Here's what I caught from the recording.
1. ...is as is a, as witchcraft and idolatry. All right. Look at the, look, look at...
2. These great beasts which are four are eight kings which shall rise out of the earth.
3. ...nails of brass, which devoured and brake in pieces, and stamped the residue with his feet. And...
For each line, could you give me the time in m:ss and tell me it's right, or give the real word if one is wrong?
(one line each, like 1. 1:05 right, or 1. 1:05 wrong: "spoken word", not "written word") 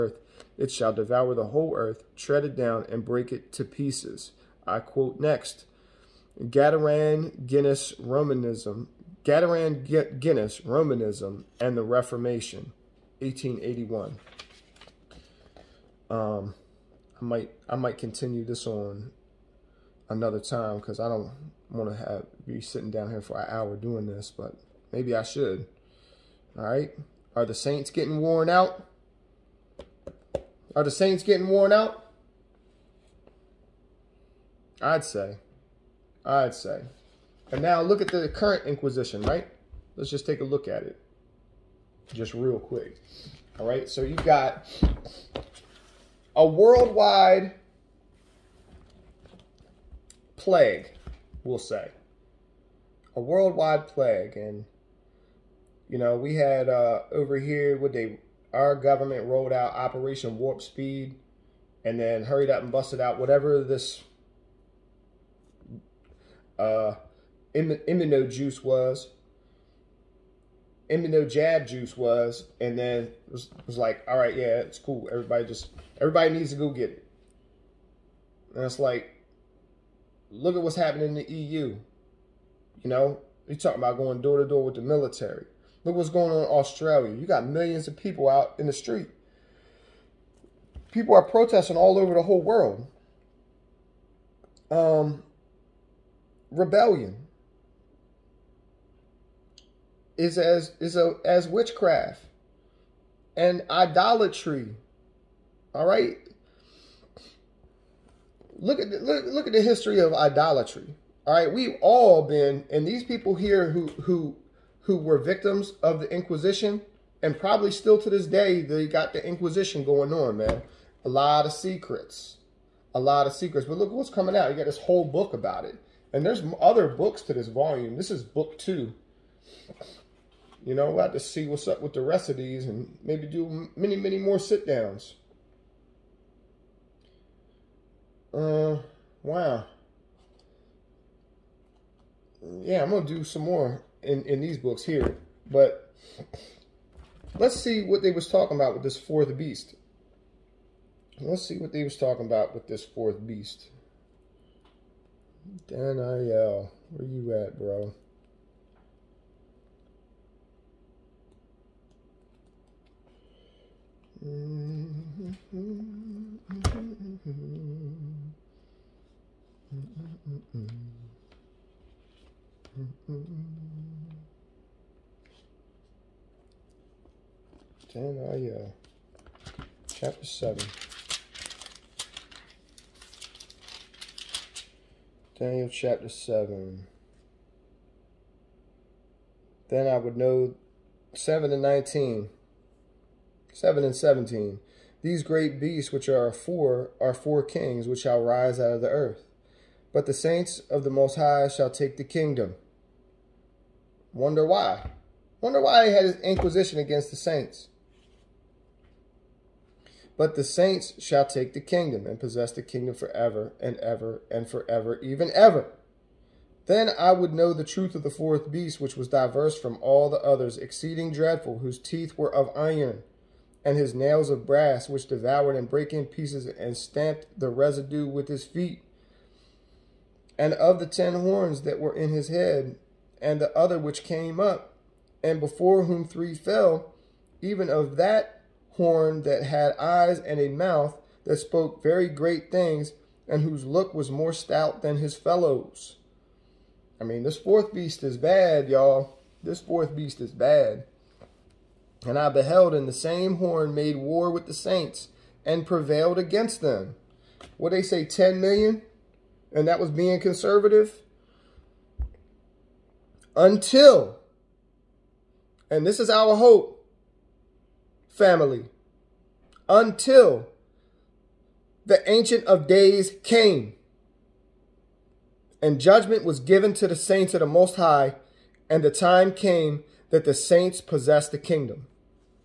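1. 1:40 right
2. 3:15 wrong: "four", not "eight"
3. 3:43 right.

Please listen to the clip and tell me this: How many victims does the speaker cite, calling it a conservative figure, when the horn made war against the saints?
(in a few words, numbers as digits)
10 million.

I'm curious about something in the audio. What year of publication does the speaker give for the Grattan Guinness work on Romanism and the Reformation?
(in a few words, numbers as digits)
1881.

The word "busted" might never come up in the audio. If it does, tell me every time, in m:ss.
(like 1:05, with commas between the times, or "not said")
1:02.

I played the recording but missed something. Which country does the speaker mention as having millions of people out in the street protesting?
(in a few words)
Australia.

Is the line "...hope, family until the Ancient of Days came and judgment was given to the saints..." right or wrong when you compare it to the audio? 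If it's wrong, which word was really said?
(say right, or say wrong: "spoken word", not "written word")
right.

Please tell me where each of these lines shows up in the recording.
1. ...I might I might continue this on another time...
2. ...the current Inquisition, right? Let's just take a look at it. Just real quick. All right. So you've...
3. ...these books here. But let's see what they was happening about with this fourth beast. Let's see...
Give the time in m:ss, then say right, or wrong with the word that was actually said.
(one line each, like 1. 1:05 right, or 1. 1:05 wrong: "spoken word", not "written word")
1. 0:17 right
2. 0:38 right
3. 2:24 wrong: "talking", not "happening".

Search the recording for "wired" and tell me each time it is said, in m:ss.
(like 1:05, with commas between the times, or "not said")
not said.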